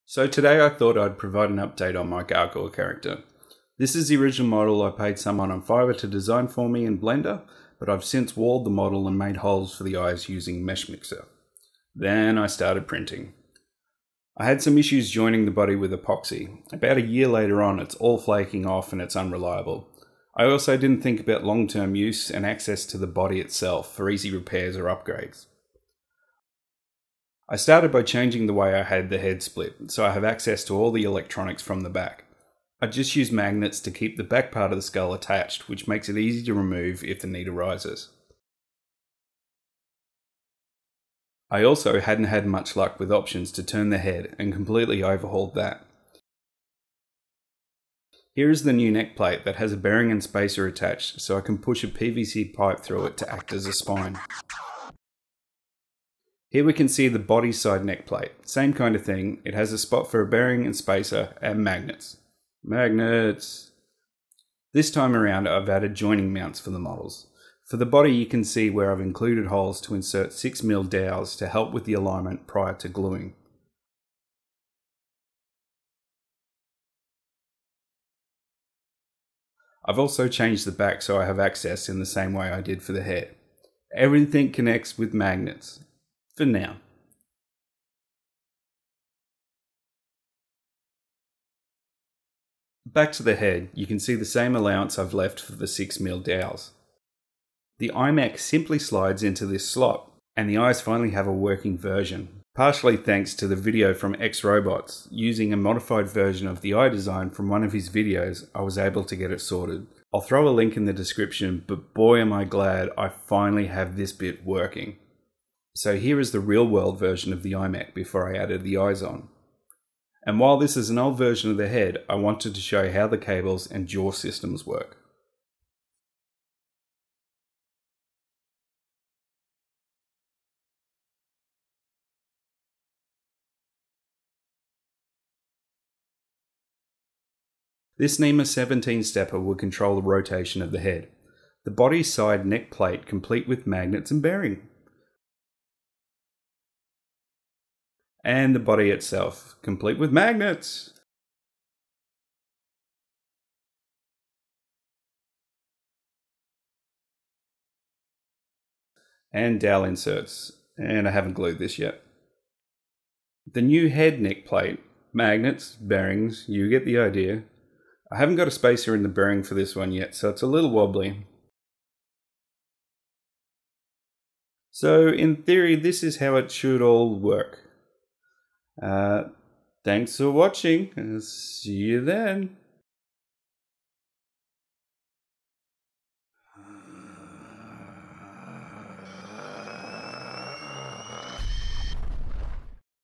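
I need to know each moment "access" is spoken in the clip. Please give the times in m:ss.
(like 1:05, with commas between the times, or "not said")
0:22, 0:30, 1:21.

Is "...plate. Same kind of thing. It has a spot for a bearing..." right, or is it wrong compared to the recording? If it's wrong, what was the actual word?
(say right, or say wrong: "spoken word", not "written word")
right.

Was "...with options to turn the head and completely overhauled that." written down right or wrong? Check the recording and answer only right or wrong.
right.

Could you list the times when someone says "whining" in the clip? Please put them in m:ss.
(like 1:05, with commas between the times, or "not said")
not said.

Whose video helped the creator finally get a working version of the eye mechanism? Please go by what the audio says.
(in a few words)
XRobots.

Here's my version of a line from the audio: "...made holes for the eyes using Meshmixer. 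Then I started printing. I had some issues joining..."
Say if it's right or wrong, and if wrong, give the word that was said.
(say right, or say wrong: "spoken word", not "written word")
right.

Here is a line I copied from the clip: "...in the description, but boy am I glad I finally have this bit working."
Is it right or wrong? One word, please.
right.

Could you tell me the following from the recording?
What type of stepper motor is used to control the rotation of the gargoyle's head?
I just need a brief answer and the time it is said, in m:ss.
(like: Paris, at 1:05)
NEMA 17, at 2:18.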